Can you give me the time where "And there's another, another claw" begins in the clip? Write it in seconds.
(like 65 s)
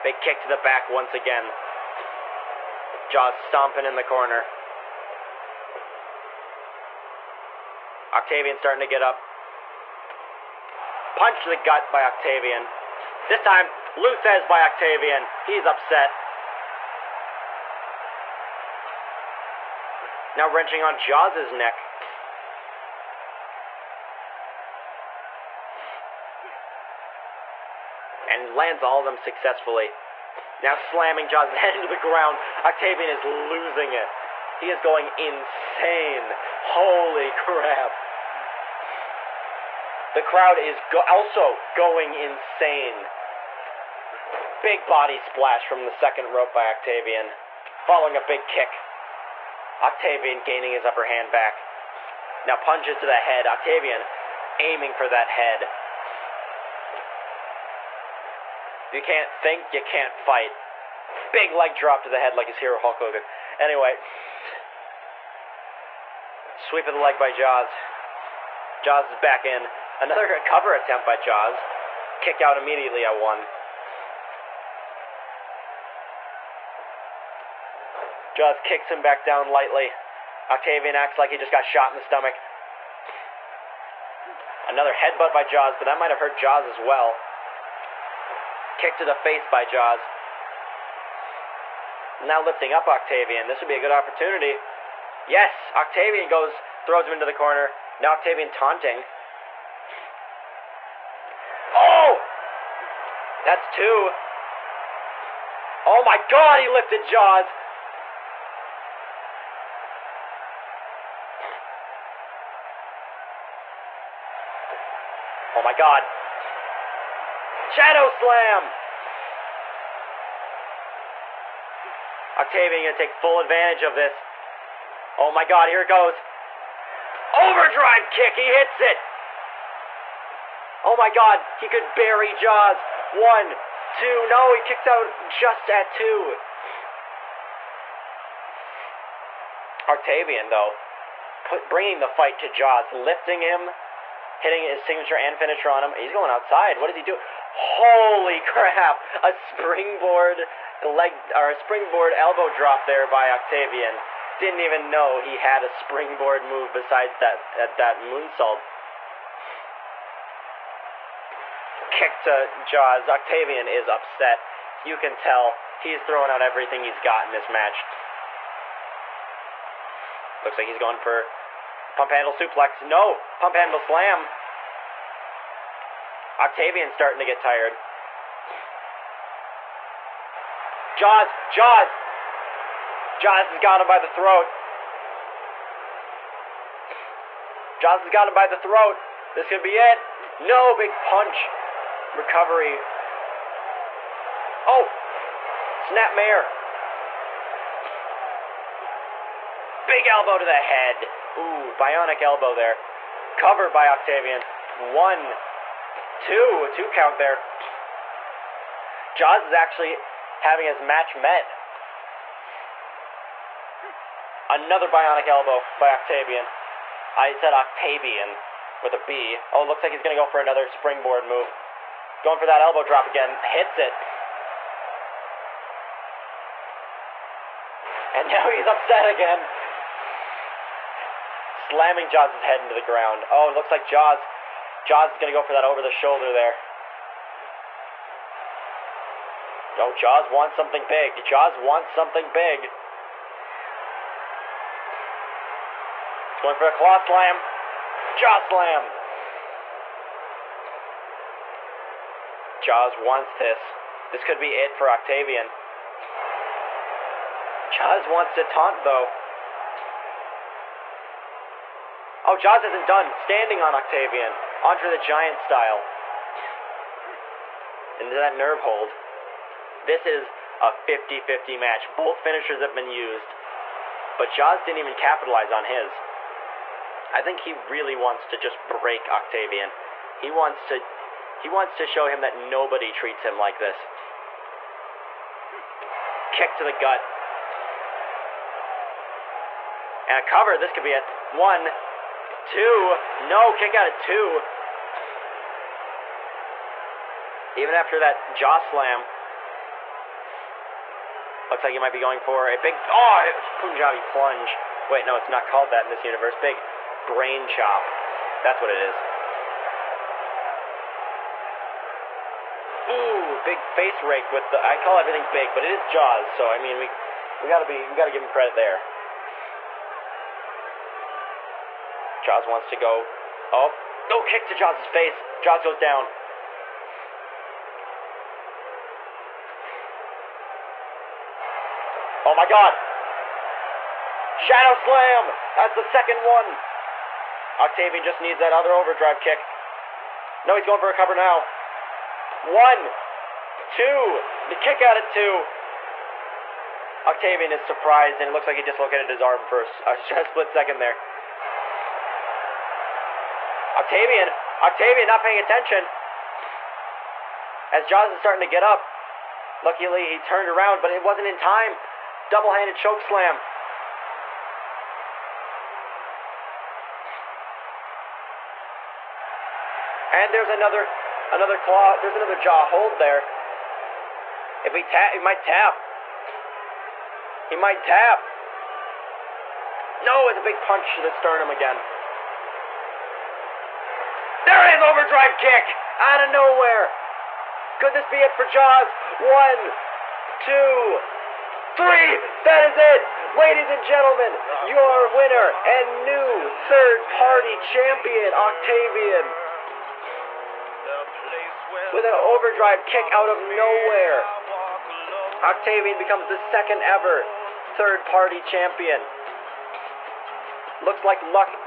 370 s.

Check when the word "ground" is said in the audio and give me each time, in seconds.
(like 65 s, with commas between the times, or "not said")
31 s, 232 s.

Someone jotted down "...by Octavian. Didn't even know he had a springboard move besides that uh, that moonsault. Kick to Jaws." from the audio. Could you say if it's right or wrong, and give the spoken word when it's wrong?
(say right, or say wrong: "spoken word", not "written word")
right.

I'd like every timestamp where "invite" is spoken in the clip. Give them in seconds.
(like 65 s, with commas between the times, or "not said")
not said.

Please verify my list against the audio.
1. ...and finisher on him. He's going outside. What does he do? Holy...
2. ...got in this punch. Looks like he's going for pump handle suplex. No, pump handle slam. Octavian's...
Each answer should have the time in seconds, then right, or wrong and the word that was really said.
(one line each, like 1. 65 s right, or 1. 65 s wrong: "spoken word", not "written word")
1. 145 s right
2. 167 s wrong: "match", not "punch".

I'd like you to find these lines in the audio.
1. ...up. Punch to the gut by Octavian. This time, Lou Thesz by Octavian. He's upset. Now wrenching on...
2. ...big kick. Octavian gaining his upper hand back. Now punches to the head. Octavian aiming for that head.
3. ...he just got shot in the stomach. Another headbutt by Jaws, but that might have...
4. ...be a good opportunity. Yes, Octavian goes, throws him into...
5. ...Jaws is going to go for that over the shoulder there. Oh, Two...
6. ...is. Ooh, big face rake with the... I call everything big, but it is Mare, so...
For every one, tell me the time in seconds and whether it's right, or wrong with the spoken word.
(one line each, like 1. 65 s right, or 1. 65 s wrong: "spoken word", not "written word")
1. 9 s right
2. 48 s right
3. 81 s right
4. 93 s right
5. 234 s wrong: "Jaws", not "Two"
6. 308 s wrong: "Jaws", not "Mare".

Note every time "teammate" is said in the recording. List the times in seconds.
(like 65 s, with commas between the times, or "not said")
not said.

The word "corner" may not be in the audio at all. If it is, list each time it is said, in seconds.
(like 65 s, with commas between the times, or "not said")
4 s, 97 s.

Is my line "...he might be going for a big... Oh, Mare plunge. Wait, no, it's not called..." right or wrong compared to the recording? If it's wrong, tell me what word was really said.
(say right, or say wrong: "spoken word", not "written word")
wrong: "Punjabi", not "Mare".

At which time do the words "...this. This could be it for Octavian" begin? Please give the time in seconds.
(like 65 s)
253 s.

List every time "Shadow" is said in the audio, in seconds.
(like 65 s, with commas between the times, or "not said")
117 s, 334 s.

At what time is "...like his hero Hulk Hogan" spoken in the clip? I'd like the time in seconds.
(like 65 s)
62 s.